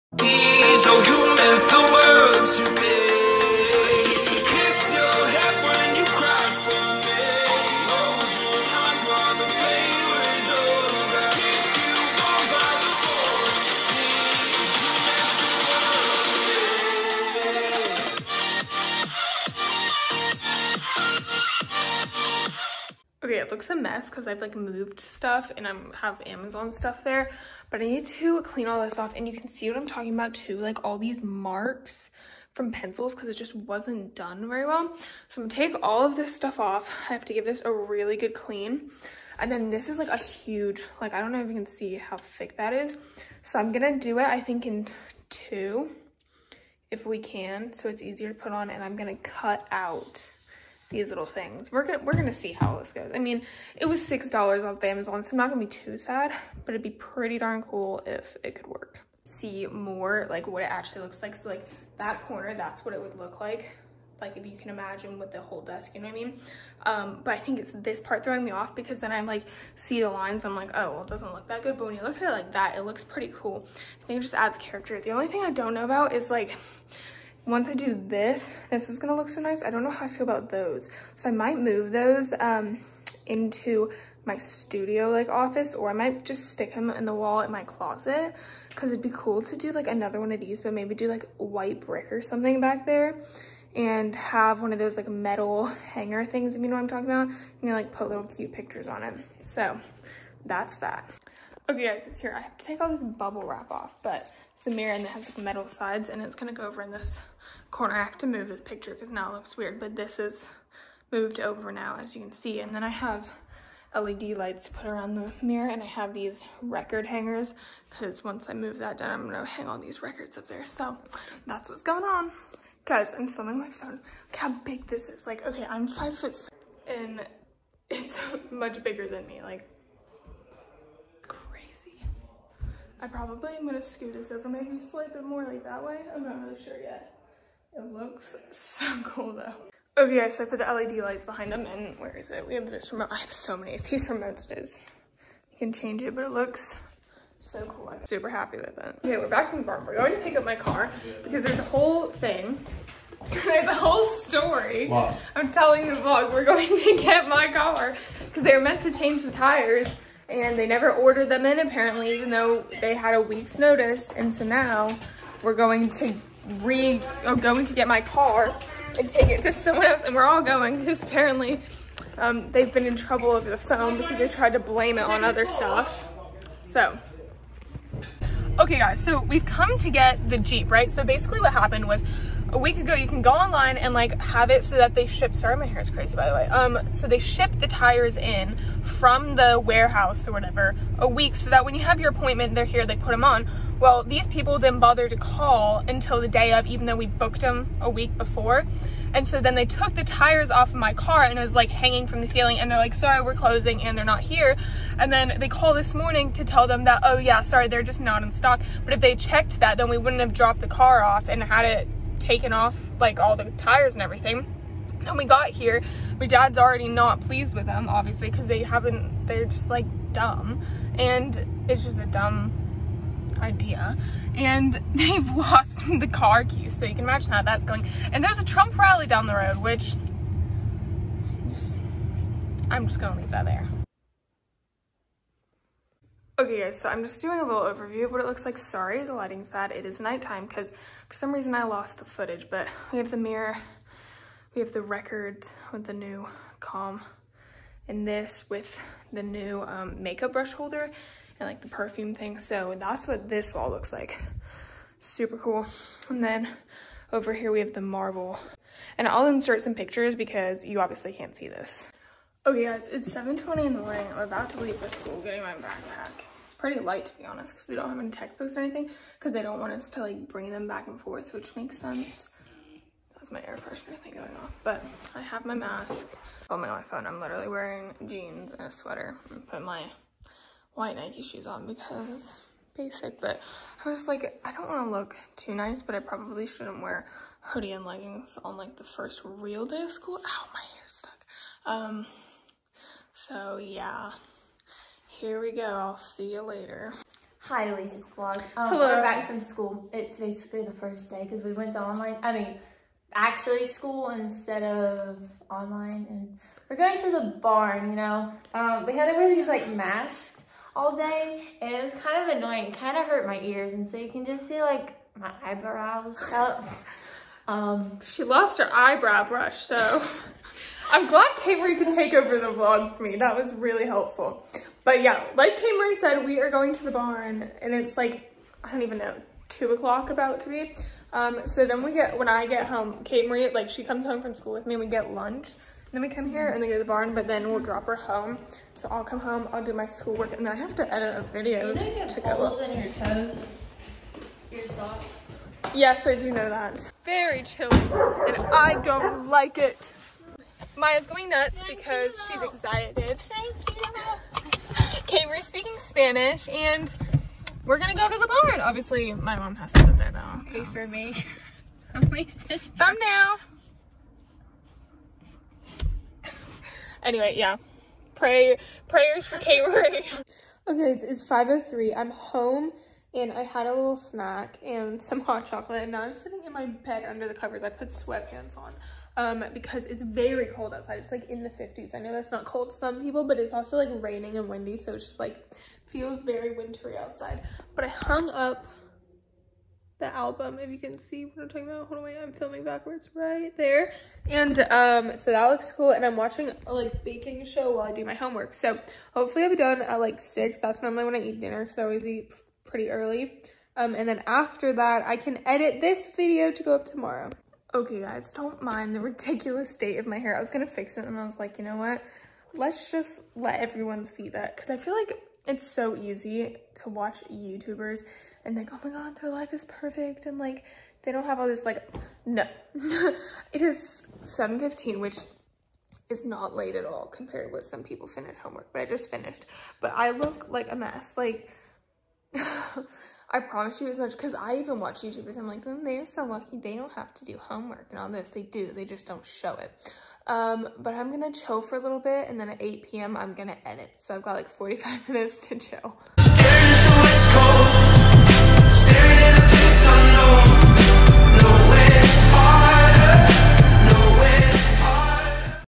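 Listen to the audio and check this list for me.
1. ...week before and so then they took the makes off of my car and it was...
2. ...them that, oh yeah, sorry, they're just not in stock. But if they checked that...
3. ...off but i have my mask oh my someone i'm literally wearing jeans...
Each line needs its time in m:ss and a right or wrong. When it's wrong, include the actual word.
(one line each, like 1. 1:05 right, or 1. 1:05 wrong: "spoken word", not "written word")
1. 3:17 wrong: "tires", not "makes"
2. 3:26 right
3. 4:34 wrong: "iphone", not "someone".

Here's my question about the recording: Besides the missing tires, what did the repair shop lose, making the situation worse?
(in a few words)
car keys.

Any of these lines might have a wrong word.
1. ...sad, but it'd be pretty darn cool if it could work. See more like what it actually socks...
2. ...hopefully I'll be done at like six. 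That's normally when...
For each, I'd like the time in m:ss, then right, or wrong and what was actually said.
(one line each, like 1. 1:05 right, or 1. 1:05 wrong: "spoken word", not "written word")
1. 0:55 wrong: "looks", not "socks"
2. 6:39 right.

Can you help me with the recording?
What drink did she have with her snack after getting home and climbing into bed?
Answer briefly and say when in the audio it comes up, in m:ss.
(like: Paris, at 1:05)
hot chocolate, at 6:15.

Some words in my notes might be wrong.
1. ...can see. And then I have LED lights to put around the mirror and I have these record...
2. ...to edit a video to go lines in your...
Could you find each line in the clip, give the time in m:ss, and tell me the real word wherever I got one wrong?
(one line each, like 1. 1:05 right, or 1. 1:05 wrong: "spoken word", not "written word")
1. 1:52 right
2. 5:40 wrong: "holes", not "lines".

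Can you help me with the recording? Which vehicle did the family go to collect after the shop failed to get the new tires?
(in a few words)
Jeep.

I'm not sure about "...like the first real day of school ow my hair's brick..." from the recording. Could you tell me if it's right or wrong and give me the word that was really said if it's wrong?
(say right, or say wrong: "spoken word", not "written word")
wrong: "stuck", not "brick".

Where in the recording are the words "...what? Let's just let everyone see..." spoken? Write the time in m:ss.
6:51.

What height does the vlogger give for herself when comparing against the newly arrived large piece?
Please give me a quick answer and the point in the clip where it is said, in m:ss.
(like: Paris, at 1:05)
5 foot 6, at 2:05.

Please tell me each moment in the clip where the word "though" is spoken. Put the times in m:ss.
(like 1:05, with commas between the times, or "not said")
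2:19, 2:42, 3:16, 6:00.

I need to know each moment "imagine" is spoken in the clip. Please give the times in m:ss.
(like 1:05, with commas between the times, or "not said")
1:04, 3:47.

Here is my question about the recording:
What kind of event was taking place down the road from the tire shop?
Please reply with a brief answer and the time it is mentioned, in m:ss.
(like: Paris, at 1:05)
Trump rally, at 3:48.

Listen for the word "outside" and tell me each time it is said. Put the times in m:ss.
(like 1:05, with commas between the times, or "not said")
6:20, 6:26.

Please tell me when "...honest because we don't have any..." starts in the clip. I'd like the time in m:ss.
4:27.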